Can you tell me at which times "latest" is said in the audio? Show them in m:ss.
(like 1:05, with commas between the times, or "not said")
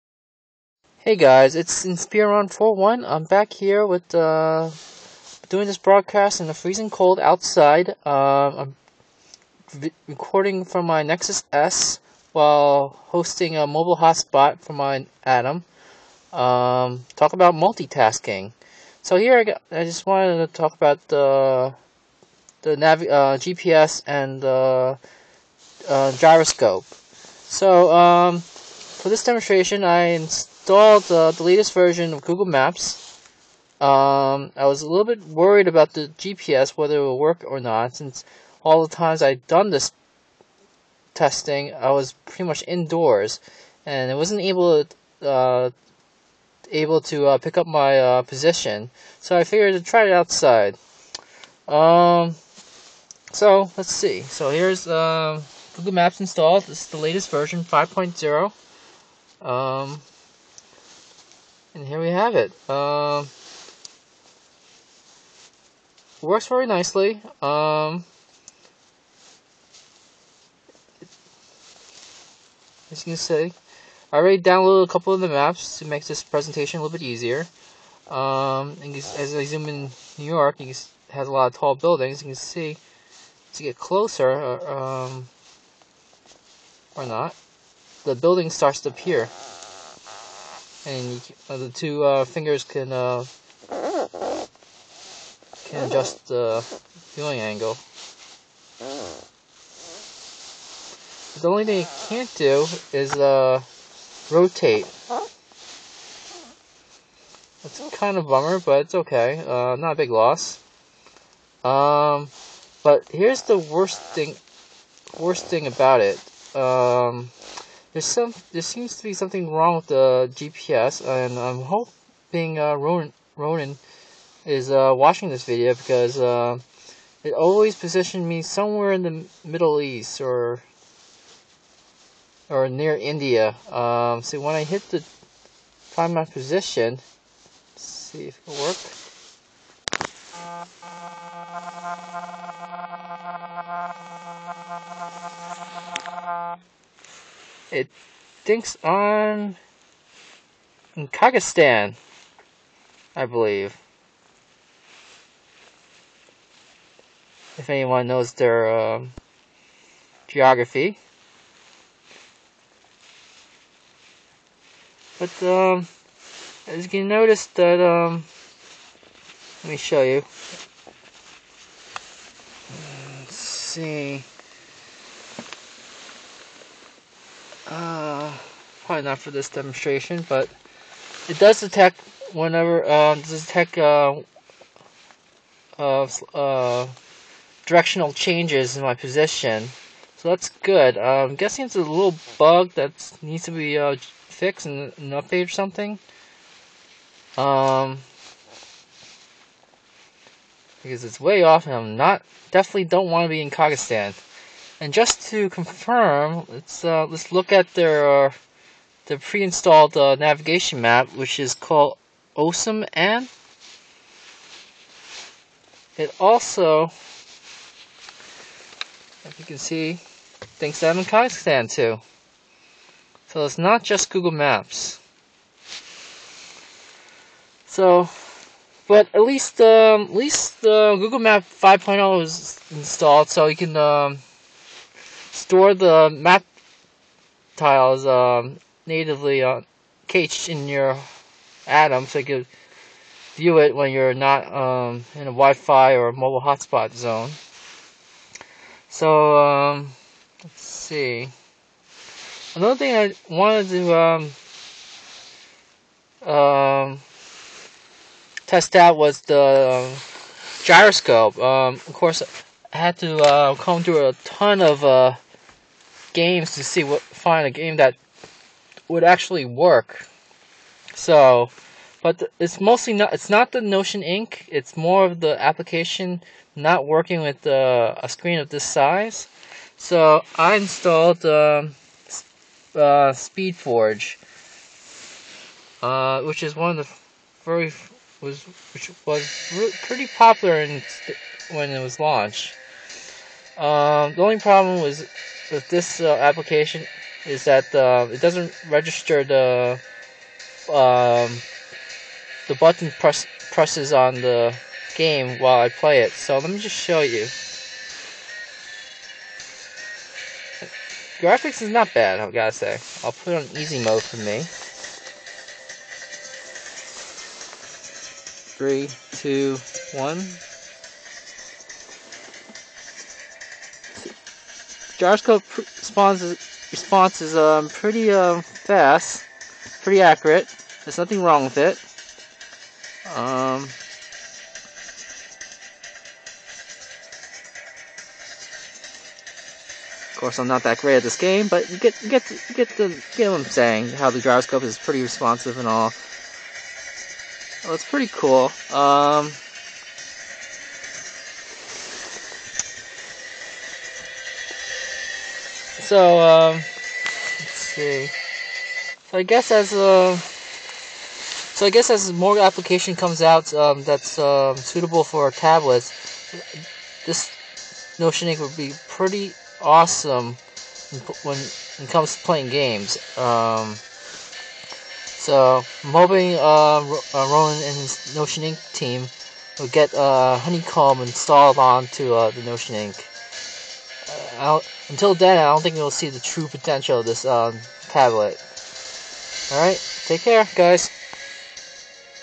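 0:31, 0:56.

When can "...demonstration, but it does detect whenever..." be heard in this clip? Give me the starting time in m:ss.
2:59.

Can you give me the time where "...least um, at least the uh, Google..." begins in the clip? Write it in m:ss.
3:49.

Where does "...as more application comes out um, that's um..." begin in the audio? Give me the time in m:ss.
6:01.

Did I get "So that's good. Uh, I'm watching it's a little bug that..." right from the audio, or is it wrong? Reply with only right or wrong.
wrong.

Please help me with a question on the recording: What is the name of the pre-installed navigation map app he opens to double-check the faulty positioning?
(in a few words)
Osm.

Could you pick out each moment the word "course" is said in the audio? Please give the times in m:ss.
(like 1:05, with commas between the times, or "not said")
4:21, 5:40.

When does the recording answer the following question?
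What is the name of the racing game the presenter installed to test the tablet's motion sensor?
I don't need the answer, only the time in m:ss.
4:43.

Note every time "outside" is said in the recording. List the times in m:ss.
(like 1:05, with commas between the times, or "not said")
0:07, 0:50.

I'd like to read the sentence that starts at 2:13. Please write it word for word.
Um, so when I hit the find my position, see if it work.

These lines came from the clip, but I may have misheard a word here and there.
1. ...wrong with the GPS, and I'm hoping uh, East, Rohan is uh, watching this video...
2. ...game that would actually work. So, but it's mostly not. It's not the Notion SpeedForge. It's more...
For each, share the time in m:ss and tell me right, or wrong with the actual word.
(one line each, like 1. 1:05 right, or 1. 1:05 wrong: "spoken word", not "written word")
1. 1:59 wrong: "Rohan", not "East"
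2. 4:27 wrong: "Ink", not "SpeedForge".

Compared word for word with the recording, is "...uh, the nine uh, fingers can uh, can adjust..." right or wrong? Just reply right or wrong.
wrong.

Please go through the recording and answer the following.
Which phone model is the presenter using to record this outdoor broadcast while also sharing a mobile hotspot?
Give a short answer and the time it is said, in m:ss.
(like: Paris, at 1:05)
Nexus S, at 0:11.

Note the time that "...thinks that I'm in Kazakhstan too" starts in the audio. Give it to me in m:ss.
3:40.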